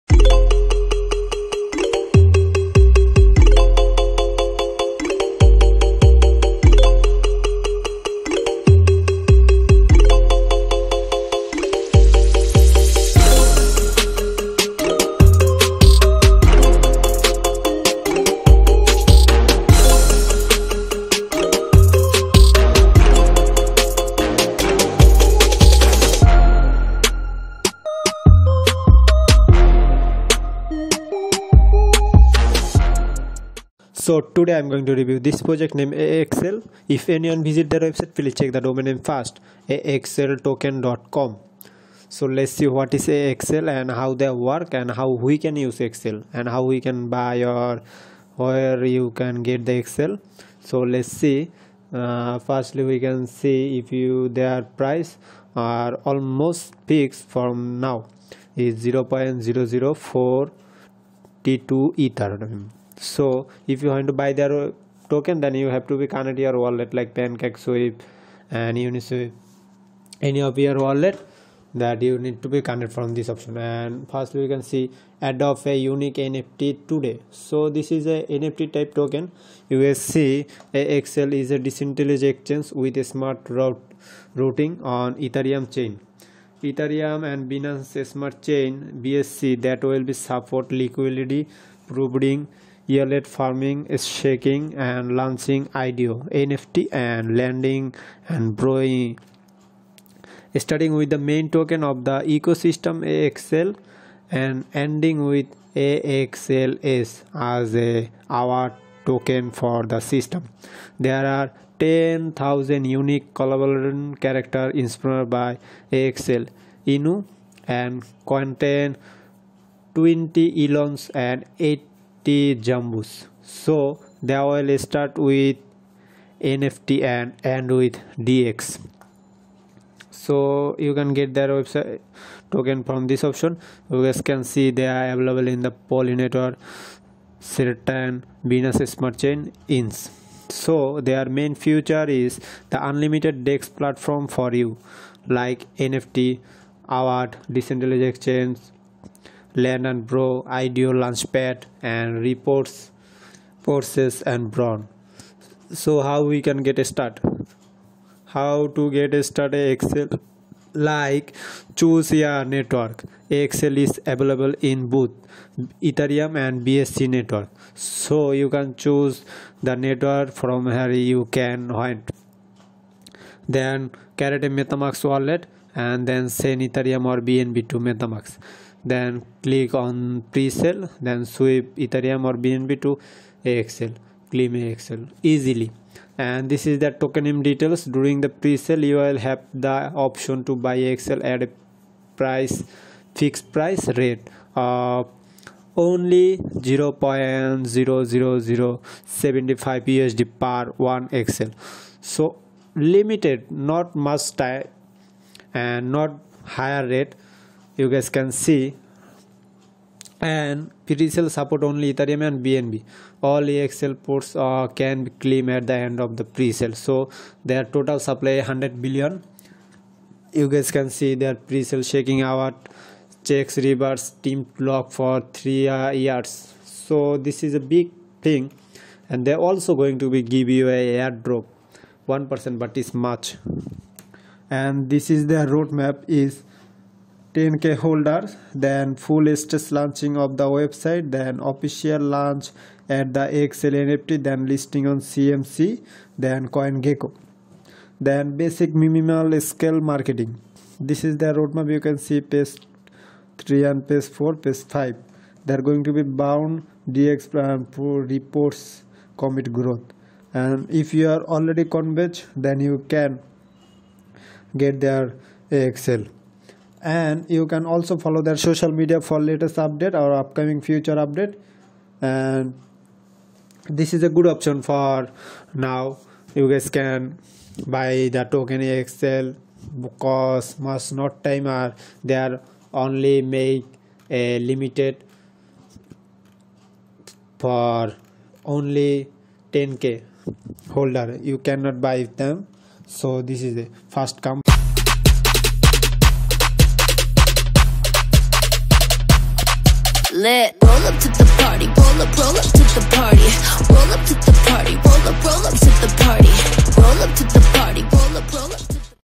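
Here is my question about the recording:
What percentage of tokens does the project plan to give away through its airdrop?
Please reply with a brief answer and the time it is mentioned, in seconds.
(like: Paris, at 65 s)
1%, at 232 s.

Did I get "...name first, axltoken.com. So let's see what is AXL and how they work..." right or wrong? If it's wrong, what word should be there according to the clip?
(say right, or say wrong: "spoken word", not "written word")
right.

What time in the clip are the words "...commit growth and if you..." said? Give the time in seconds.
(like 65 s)
259 s.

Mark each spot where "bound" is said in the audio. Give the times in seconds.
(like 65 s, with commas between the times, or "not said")
256 s.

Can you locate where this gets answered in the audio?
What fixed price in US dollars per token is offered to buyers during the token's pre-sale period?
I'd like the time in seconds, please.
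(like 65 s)
196 s.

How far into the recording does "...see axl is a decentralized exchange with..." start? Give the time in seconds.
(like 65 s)
79 s.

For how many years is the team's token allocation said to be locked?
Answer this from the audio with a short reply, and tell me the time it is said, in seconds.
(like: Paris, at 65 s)
3 years, at 225 s.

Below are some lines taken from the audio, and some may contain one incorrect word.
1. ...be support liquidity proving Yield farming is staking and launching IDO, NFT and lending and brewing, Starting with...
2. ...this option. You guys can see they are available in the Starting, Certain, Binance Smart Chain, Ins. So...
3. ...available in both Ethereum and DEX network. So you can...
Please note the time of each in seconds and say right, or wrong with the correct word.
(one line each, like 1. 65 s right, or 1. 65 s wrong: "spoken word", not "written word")
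1. 90 s right
2. 133 s wrong: "Pollinator", not "Starting"
3. 164 s wrong: "BSC", not "DEX".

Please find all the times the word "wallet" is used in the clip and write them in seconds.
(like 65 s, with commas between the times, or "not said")
66 s, 70 s, 175 s.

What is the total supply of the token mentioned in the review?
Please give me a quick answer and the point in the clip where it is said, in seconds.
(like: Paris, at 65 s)
100 billion, at 218 s.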